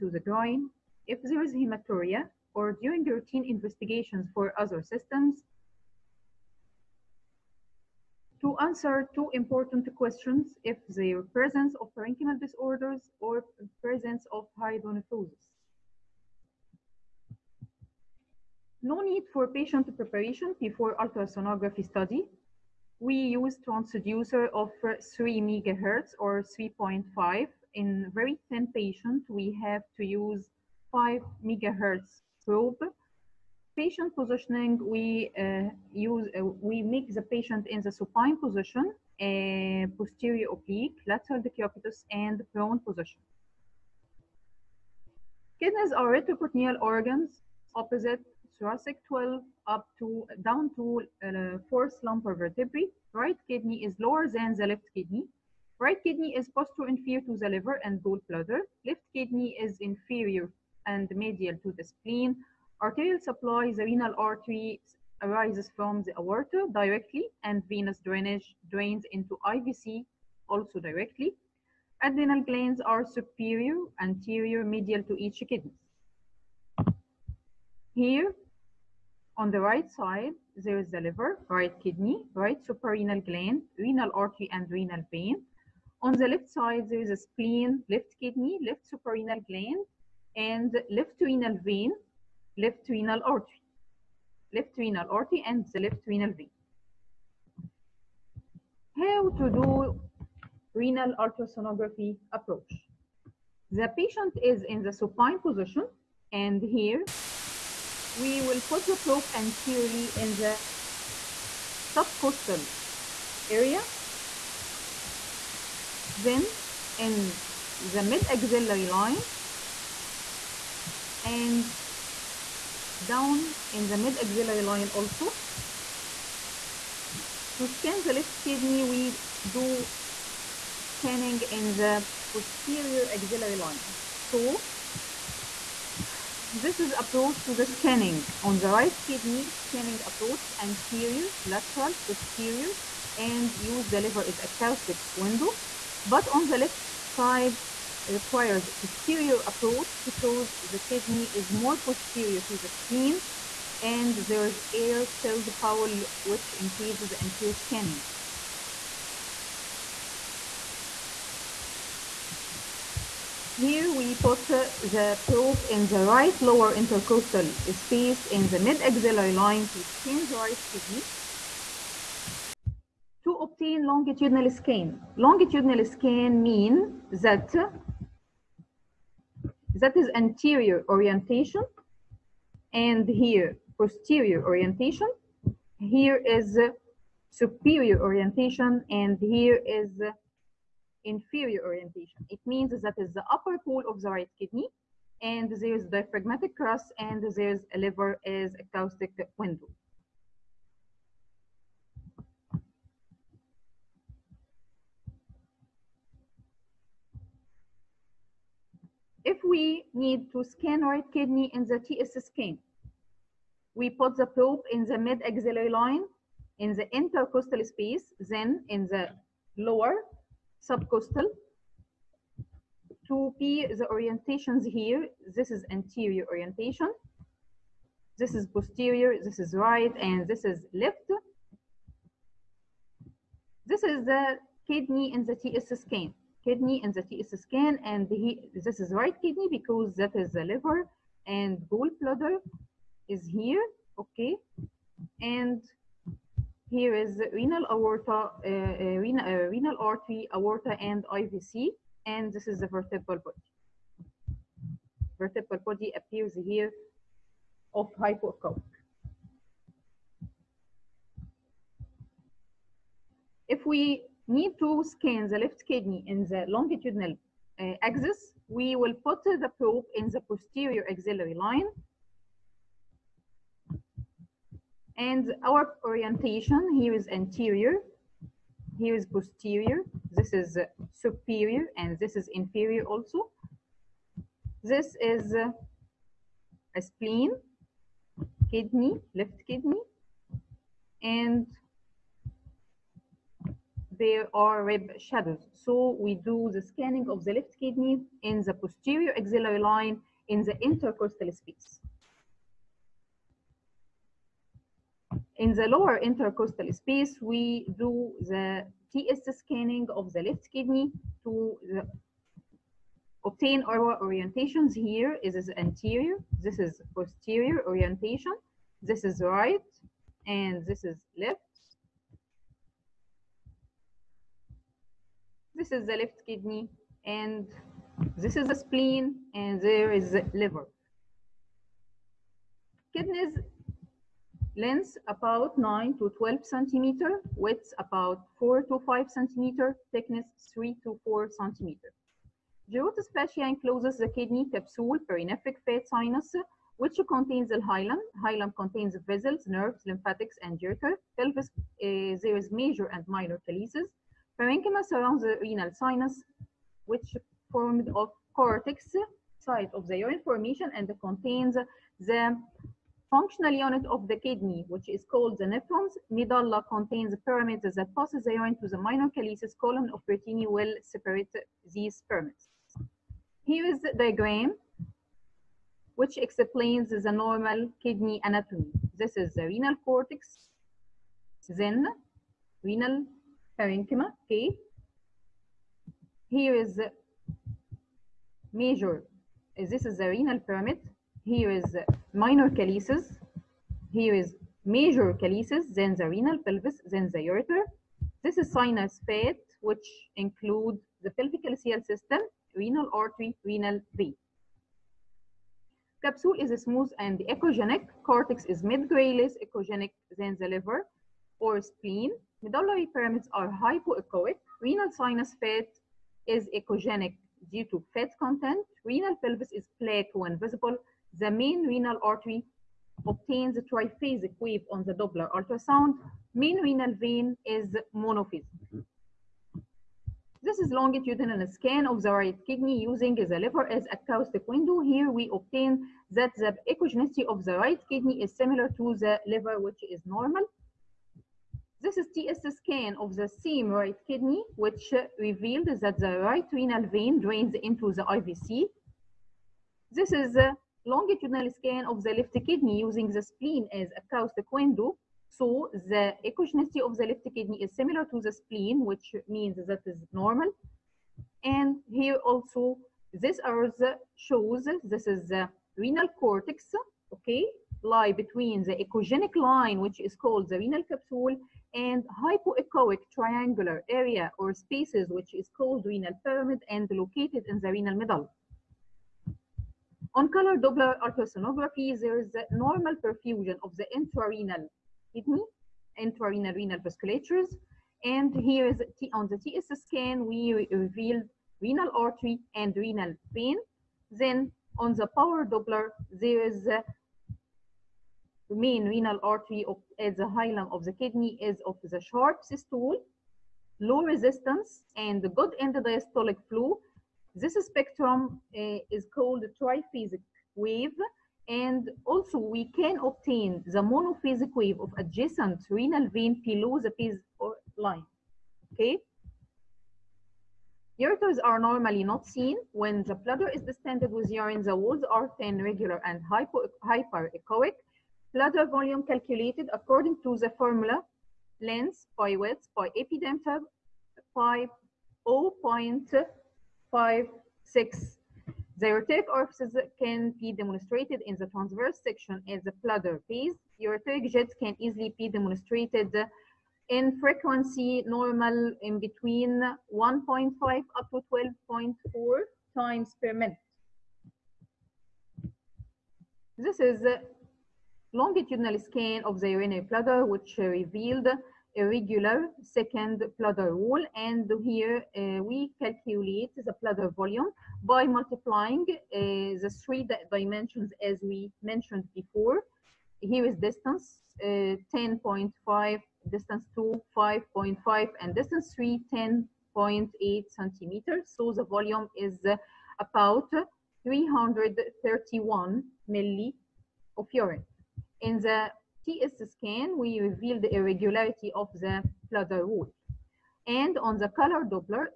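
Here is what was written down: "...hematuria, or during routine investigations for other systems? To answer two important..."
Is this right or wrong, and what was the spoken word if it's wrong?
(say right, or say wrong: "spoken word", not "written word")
right.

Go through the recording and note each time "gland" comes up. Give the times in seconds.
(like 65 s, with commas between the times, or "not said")
72 s, 83 s, 89 s.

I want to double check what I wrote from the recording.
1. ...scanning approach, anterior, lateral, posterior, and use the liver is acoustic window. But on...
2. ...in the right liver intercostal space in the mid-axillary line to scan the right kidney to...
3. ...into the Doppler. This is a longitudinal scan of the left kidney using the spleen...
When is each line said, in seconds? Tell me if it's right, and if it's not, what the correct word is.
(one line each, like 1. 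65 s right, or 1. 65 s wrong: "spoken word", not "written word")
1. 139 s right
2. 165 s wrong: "lower", not "liver"
3. 447 s wrong: "IVC", not "Doppler".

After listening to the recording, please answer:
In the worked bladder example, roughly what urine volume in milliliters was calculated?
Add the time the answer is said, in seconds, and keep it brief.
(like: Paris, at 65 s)
331, at 584 s.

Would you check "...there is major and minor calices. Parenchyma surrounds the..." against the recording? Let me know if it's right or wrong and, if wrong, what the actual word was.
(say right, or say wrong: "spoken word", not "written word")
right.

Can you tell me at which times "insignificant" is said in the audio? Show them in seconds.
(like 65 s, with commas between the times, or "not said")
not said.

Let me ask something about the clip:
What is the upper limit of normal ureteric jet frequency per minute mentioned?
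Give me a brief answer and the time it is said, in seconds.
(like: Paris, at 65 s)
12.4, at 551 s.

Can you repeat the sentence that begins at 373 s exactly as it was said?
Here is the diagram which explains the normal kidney anatomy.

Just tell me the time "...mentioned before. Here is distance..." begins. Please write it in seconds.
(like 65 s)
571 s.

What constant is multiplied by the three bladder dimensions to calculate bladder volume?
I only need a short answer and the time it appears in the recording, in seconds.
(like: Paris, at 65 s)
0.56, at 535 s.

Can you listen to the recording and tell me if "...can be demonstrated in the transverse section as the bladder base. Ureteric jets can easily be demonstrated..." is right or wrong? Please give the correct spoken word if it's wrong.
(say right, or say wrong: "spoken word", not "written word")
right.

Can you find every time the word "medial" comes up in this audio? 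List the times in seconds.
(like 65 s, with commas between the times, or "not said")
61 s, 74 s.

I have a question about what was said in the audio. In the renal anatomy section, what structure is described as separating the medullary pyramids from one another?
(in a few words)
column of Bertini.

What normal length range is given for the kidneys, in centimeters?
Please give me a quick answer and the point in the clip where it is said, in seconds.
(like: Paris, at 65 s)
9 to 12 centimeters, at 335 s.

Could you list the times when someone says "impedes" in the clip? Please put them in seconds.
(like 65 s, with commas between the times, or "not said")
156 s.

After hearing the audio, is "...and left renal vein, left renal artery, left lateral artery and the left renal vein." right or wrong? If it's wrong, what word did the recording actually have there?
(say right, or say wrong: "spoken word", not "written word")
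wrong: "renal", not "lateral".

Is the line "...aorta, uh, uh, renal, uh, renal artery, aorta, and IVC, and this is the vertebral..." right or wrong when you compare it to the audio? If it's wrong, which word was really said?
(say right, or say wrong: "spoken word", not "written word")
right.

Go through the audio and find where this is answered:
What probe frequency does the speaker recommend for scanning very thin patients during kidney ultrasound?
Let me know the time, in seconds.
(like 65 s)
30 s.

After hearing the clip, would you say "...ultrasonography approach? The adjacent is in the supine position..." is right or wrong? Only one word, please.
wrong.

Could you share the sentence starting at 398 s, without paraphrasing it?
This is sinus fat, which includes the pelvic calyceal system, renal artery, renal vein.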